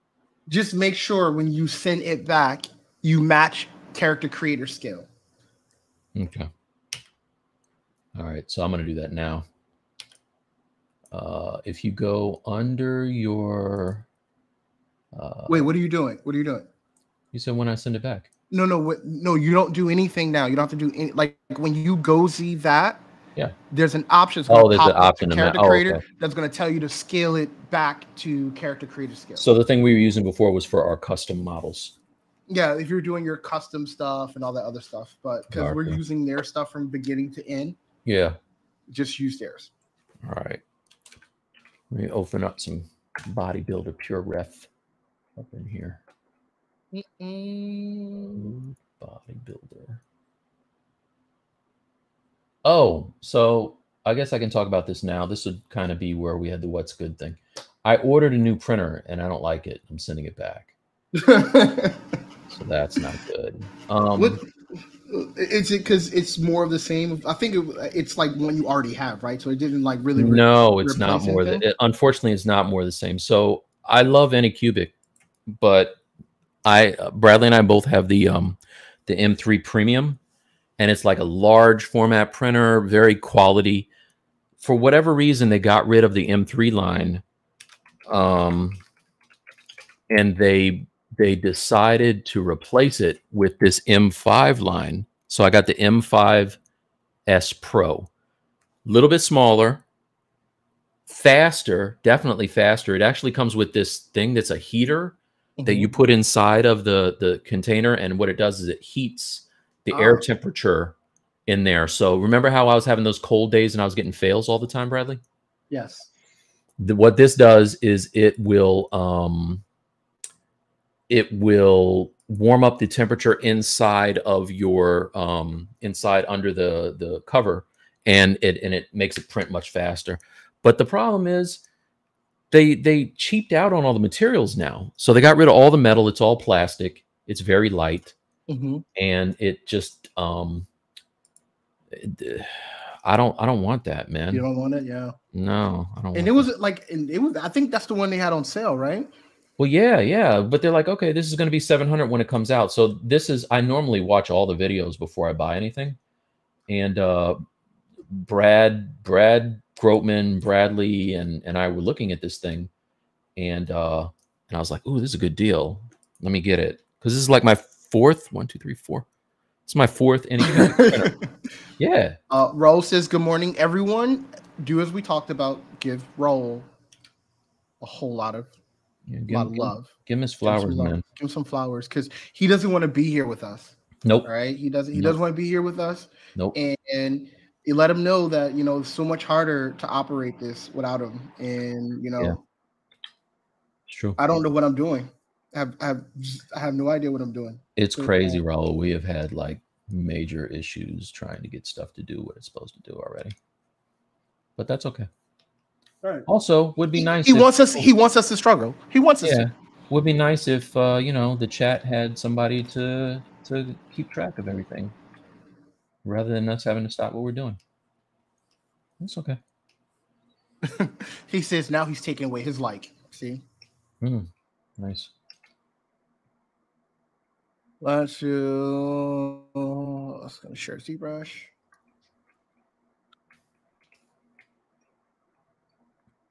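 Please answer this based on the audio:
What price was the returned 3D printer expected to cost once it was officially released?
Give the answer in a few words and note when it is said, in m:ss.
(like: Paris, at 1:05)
700, at 2:31.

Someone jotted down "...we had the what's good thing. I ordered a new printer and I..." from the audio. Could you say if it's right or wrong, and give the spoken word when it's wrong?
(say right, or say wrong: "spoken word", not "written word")
right.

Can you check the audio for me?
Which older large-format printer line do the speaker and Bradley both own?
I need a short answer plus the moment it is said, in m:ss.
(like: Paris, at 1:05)
M3 Premium, at 1:19.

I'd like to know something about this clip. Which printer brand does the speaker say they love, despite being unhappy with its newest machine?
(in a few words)
AnyCubic.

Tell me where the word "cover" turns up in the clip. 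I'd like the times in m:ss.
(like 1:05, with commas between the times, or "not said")
2:07.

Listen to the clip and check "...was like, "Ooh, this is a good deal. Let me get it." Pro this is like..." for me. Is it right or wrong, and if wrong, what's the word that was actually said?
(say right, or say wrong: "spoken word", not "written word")
wrong: "Because", not "Pro".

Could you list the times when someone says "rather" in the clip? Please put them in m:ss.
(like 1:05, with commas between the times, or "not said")
3:36.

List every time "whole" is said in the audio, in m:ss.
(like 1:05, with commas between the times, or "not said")
2:57.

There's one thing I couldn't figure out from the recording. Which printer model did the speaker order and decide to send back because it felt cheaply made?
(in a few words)
M5S Pro.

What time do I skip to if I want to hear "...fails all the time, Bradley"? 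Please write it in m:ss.
1:54.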